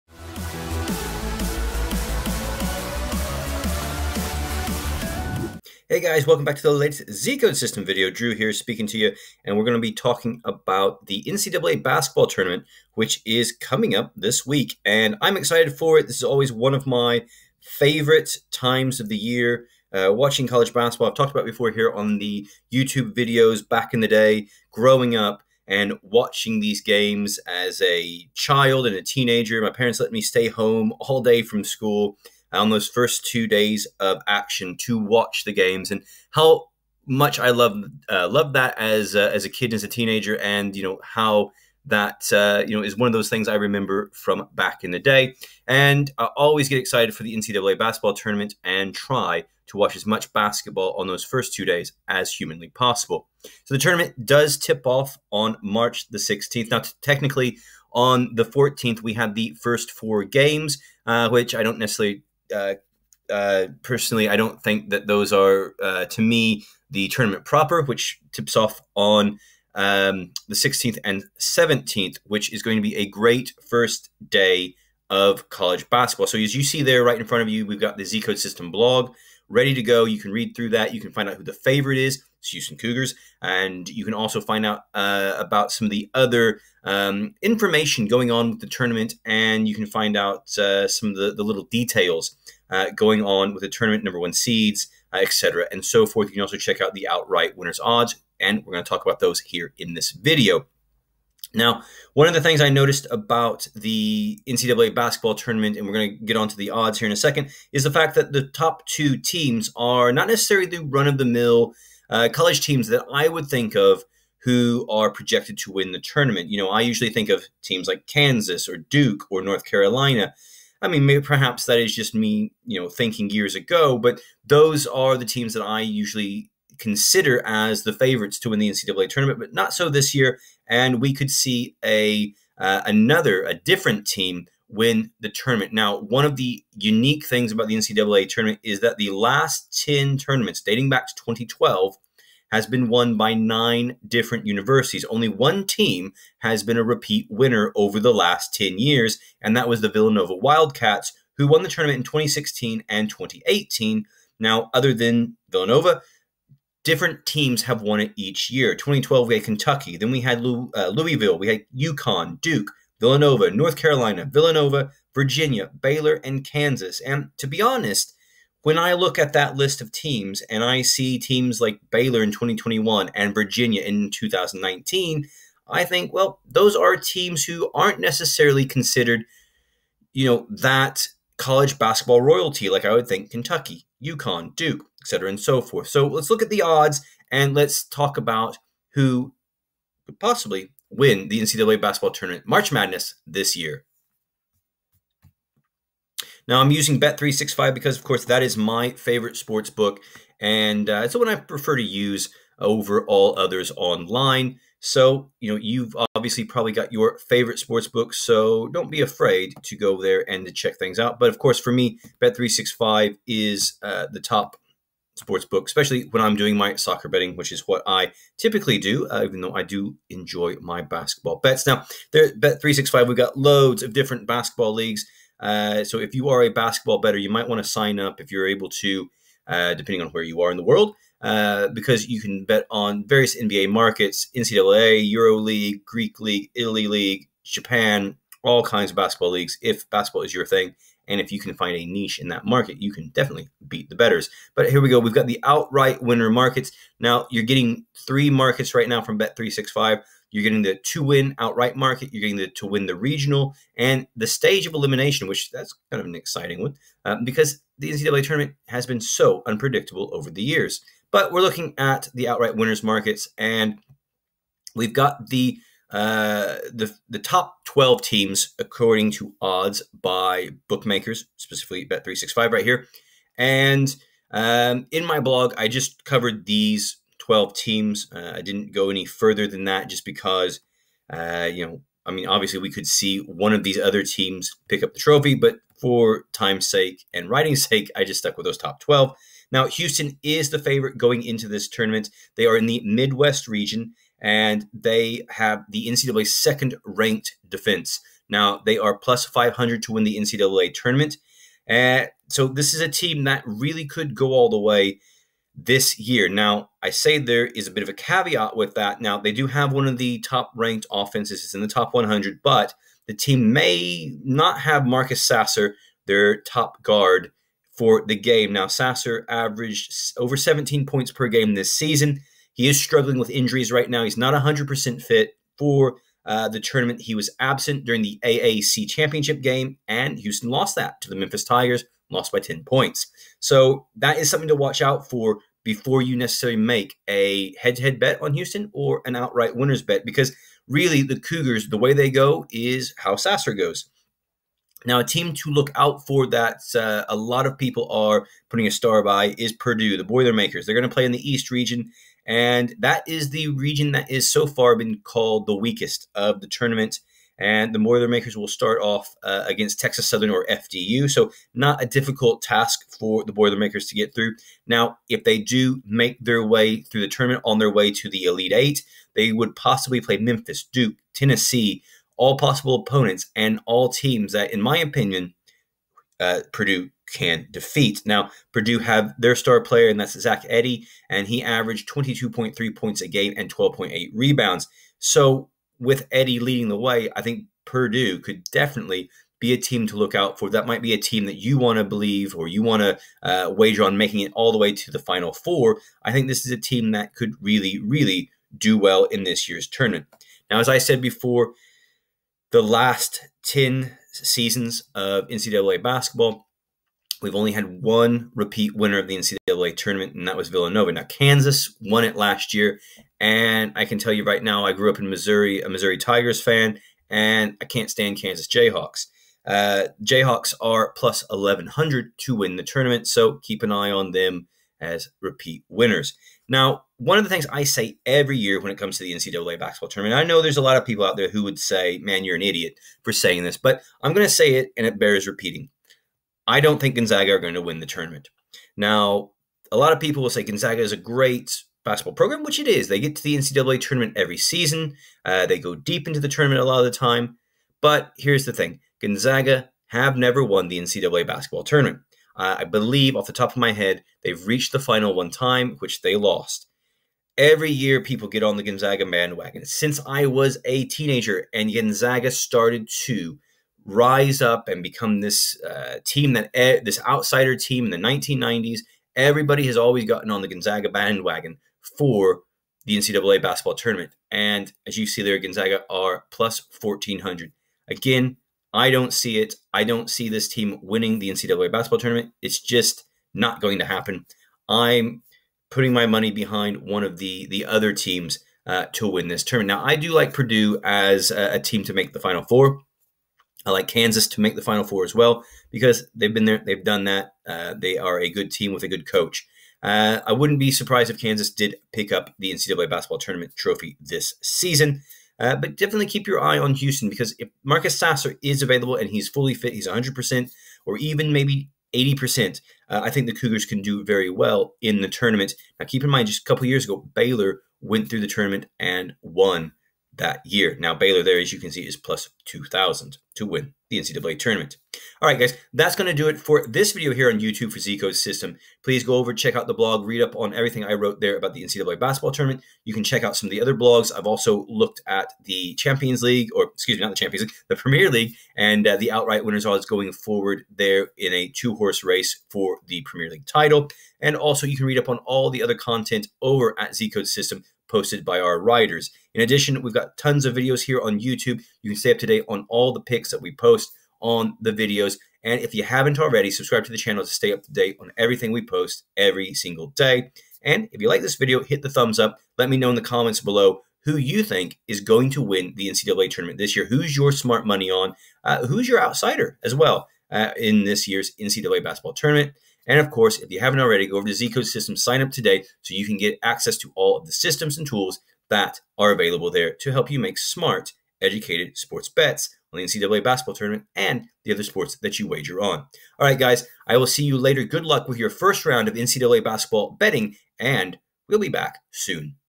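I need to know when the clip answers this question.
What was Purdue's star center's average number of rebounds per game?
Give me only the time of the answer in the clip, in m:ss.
6:23.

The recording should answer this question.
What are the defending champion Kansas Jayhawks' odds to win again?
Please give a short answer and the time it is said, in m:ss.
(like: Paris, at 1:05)
+1100, at 7:00.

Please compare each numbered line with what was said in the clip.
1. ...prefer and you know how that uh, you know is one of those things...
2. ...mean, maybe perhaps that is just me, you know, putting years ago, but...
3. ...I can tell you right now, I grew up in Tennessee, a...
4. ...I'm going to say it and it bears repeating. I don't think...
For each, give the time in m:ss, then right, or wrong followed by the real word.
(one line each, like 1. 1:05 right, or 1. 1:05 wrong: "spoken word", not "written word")
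1. 0:39 wrong: "teenager", not "prefer"
2. 2:00 wrong: "thinking", not "putting"
3. 6:53 wrong: "Missouri", not "Tennessee"
4. 7:14 right.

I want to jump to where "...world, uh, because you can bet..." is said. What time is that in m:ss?
3:50.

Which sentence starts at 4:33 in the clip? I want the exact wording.
And um, in my blog, I just covered these 12 teams.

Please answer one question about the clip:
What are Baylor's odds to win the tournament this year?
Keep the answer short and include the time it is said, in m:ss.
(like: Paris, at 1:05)
+2000, at 8:41.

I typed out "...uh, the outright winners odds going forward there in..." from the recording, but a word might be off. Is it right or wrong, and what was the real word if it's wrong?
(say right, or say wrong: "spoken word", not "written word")
right.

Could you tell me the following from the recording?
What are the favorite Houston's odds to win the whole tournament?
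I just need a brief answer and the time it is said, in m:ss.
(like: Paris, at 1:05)
+500, at 4:58.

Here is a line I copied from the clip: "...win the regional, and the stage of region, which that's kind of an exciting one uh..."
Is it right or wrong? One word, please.
wrong.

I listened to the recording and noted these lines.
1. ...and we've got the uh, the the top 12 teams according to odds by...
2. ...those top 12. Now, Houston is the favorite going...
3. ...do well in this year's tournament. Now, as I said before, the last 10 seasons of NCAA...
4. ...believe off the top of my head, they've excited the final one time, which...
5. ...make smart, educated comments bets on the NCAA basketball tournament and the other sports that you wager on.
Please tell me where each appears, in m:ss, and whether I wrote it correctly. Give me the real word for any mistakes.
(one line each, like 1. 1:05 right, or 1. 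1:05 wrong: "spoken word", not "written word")
1. 4:23 right
2. 4:48 right
3. 6:38 right
4. 7:32 wrong: "reached", not "excited"
5. 9:40 wrong: "sports", not "comments".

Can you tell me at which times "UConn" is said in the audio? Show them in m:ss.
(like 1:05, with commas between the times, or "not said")
2:41, 3:04.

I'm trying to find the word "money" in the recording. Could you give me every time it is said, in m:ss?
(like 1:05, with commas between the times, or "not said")
8:06, 9:27.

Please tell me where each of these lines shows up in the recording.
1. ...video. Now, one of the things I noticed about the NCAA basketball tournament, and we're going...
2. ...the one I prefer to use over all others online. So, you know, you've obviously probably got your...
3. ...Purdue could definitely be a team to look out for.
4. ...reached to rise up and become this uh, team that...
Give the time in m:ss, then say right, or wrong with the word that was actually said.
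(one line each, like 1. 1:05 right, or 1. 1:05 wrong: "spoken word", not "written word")
1. 1:40 right
2. 3:21 right
3. 6:27 right
4. 7:42 wrong: "started", not "reached".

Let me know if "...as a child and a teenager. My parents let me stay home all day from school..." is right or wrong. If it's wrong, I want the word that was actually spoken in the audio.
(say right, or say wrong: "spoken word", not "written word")
right.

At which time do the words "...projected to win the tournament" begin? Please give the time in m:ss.
1:55.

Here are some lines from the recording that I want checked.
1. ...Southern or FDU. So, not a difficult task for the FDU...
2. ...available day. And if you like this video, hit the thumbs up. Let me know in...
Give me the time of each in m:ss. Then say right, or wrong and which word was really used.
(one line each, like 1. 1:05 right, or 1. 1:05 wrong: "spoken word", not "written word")
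1. 6:00 wrong: "Boilermakers", not "FDU"
2. 9:19 wrong: "single", not "available".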